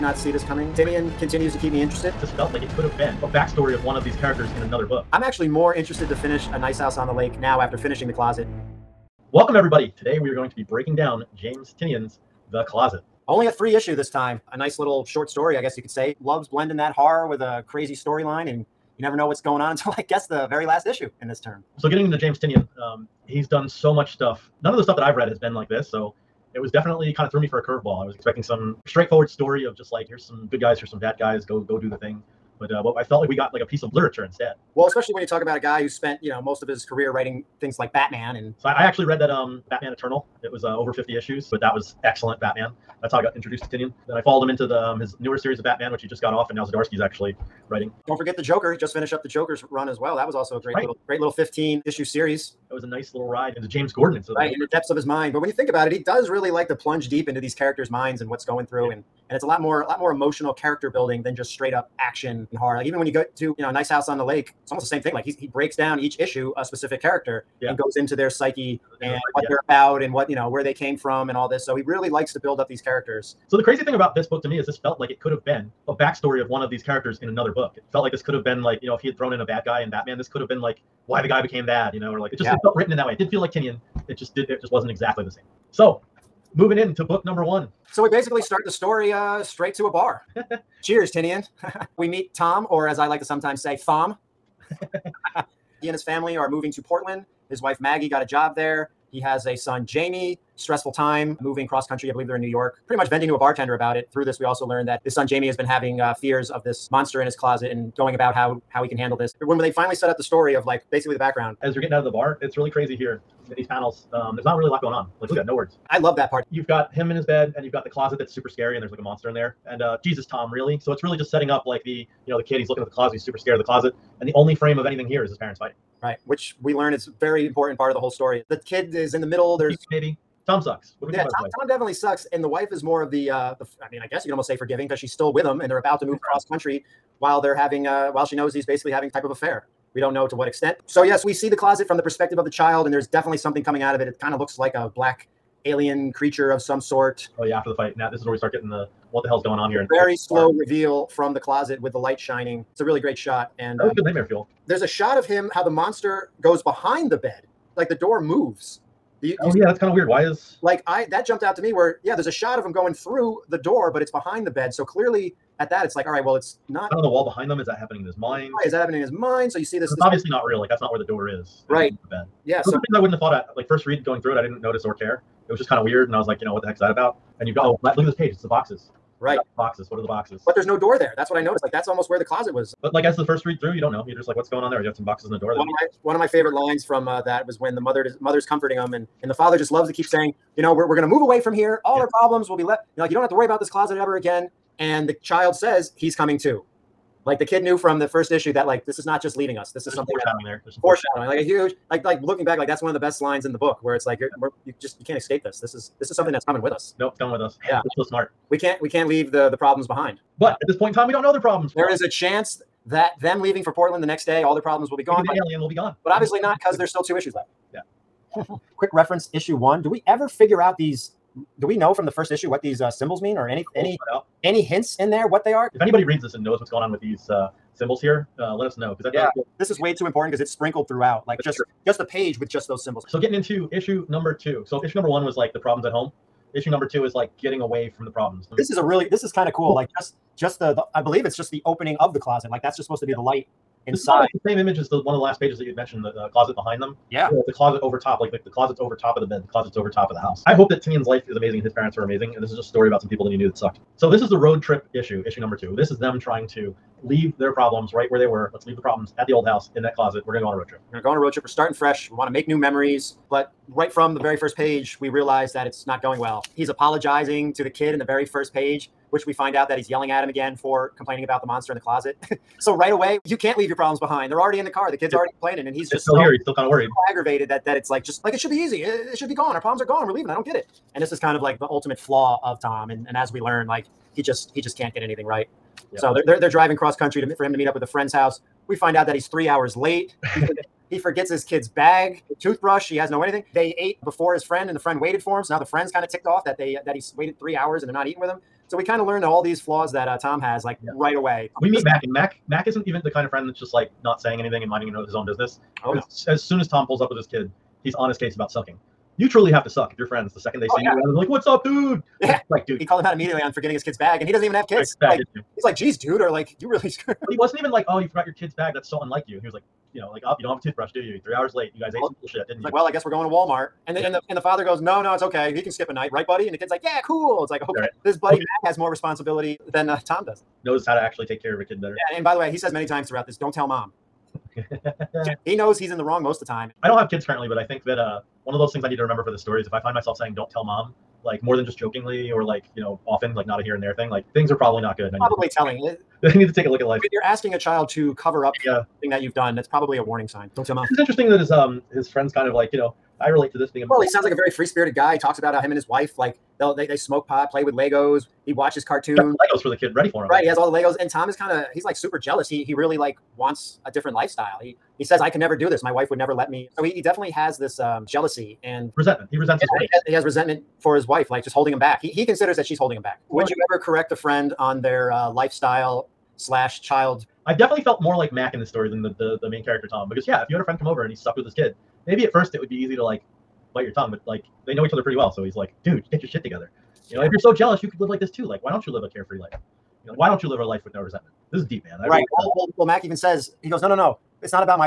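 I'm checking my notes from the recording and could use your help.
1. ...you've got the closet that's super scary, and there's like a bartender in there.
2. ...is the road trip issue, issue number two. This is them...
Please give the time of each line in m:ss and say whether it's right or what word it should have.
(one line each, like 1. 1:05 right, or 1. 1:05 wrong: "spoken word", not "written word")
1. 1:57 wrong: "monster", not "bartender"
2. 4:14 right.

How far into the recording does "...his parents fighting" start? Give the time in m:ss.
2:05.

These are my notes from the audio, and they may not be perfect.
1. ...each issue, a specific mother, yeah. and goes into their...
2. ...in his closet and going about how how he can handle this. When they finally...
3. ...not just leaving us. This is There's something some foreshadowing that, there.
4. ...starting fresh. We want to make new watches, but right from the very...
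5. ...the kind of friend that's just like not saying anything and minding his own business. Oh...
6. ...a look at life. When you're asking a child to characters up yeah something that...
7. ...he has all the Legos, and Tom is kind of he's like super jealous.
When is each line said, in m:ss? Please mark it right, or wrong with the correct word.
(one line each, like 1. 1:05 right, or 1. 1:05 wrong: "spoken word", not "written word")
1. 1:05 wrong: "character", not "mother"
2. 1:47 right
3. 3:19 right
4. 4:21 wrong: "memories", not "watches"
5. 5:03 right
6. 5:46 wrong: "cover", not "characters"
7. 6:00 right.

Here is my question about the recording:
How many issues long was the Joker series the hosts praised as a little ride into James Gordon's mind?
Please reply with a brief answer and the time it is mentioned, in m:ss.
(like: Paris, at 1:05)
15, at 0:51.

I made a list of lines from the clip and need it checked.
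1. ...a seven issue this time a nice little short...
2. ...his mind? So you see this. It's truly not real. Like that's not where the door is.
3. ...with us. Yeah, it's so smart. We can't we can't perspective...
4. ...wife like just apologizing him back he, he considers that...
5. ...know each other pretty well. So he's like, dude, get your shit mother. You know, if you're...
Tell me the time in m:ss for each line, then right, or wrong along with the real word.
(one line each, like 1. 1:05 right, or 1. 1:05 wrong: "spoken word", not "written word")
1. 0:13 wrong: "three", not "seven"
2. 2:49 wrong: "obviously", not "truly"
3. 3:27 wrong: "leave", not "perspective"
4. 6:11 wrong: "holding", not "apologizing"
5. 6:24 wrong: "together", not "mother".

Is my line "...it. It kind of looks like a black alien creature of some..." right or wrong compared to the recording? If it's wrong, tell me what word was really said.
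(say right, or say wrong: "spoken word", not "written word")
right.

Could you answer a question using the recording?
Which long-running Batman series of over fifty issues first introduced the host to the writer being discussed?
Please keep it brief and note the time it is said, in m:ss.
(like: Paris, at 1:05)
Batman Eternal, at 0:39.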